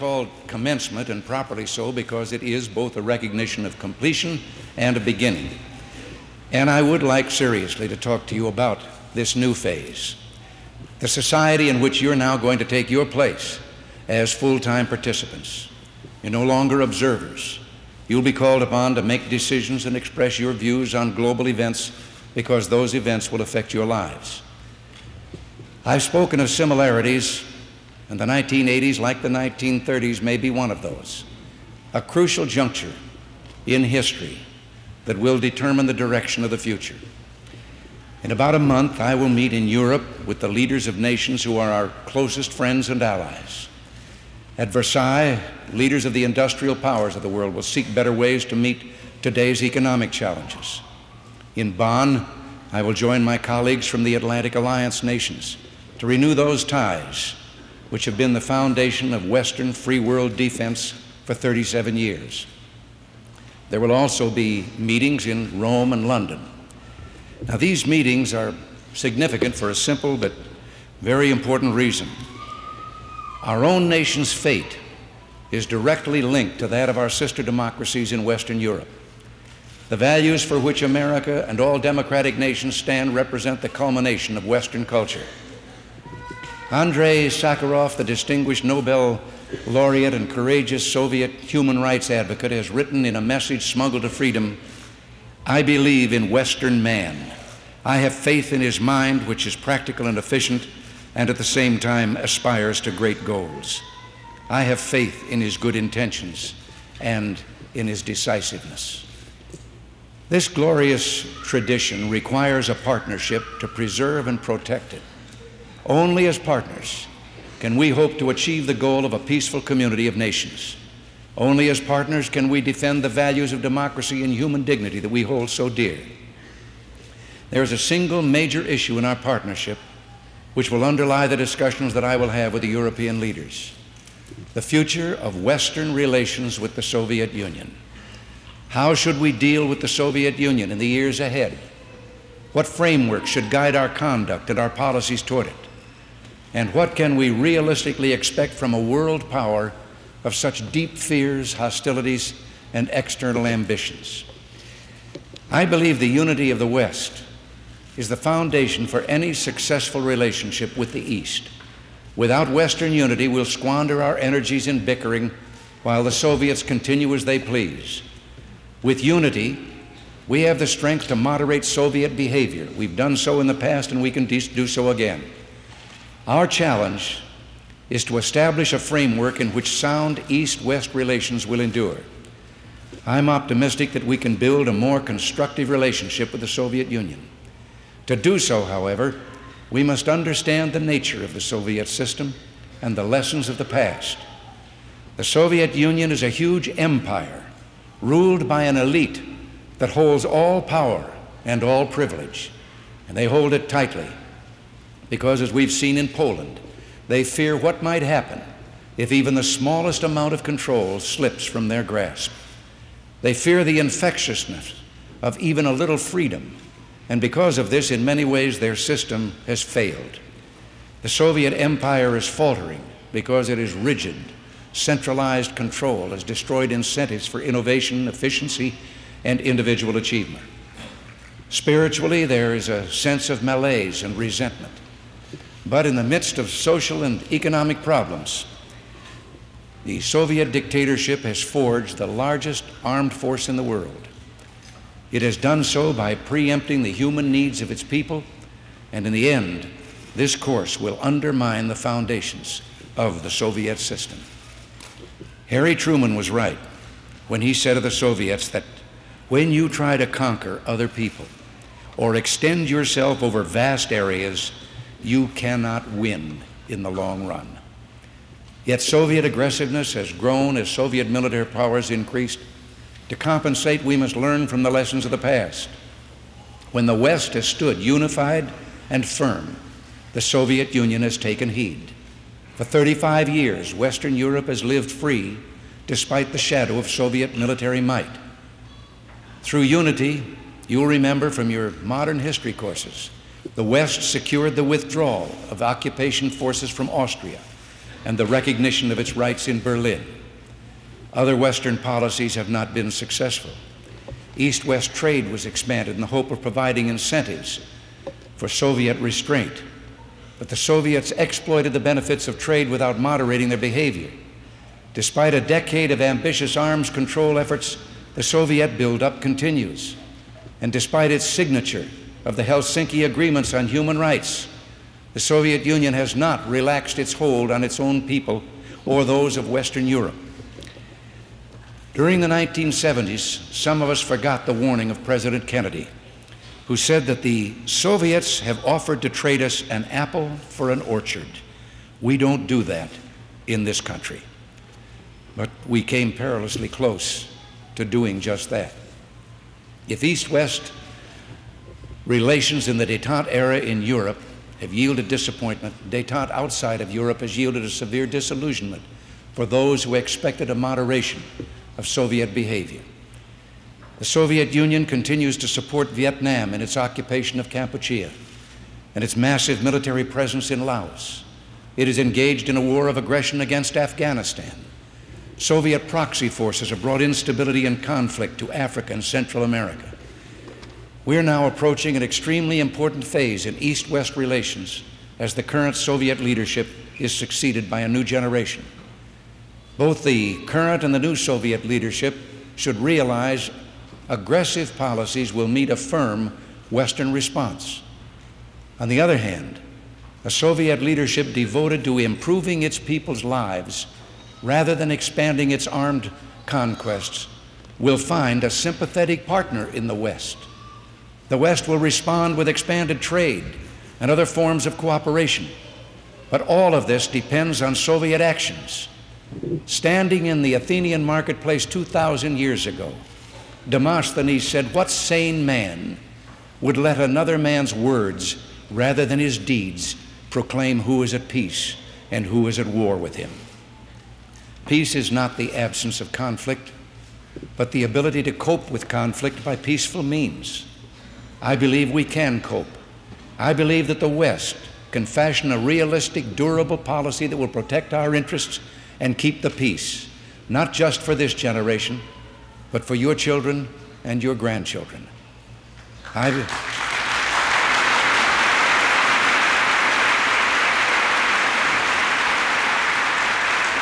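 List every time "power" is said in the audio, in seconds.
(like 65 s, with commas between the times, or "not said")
46 s, 149 s, 200 s, 271 s.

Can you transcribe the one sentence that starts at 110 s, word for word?
This glorious tradition requires a partnership to preserve and protect it.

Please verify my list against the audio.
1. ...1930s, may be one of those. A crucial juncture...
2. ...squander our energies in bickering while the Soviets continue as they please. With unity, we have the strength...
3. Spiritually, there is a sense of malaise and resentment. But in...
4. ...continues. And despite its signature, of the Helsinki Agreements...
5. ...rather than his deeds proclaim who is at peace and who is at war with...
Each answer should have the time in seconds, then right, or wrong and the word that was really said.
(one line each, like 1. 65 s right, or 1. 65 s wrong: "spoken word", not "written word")
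1. 29 s right
2. 163 s right
3. 231 s right
4. 319 s right
5. 428 s right.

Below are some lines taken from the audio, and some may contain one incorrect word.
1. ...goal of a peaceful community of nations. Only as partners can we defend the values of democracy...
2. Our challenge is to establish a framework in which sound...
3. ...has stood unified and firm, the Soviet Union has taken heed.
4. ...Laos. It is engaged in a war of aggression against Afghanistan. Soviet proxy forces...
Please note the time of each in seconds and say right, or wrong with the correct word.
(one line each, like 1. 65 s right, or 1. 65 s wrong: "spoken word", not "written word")
1. 118 s right
2. 176 s right
3. 277 s right
4. 370 s right.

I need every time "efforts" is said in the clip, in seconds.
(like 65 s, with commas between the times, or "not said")
317 s.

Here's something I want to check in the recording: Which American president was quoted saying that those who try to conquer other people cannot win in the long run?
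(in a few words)
Harry Truman.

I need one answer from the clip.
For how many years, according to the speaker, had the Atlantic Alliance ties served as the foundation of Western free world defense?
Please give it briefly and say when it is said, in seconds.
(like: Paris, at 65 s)
37, at 61 s.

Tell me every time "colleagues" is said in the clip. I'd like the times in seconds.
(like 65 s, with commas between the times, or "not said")
53 s.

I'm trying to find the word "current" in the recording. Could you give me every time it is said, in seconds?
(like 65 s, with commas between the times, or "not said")
385 s, 390 s.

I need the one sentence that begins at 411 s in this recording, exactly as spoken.
The West will respond with expanded trade and other forms of cooperation.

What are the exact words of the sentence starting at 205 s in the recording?
Because, as we've seen in Poland, they fear what might happen if even the smallest amount of control slips from their grasp.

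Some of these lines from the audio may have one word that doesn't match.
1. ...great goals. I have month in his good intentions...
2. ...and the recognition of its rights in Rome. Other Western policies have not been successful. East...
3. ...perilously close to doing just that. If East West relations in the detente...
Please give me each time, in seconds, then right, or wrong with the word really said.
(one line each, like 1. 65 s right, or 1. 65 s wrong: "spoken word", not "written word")
1. 102 s wrong: "faith", not "month"
2. 298 s wrong: "Berlin", not "Rome"
3. 346 s right.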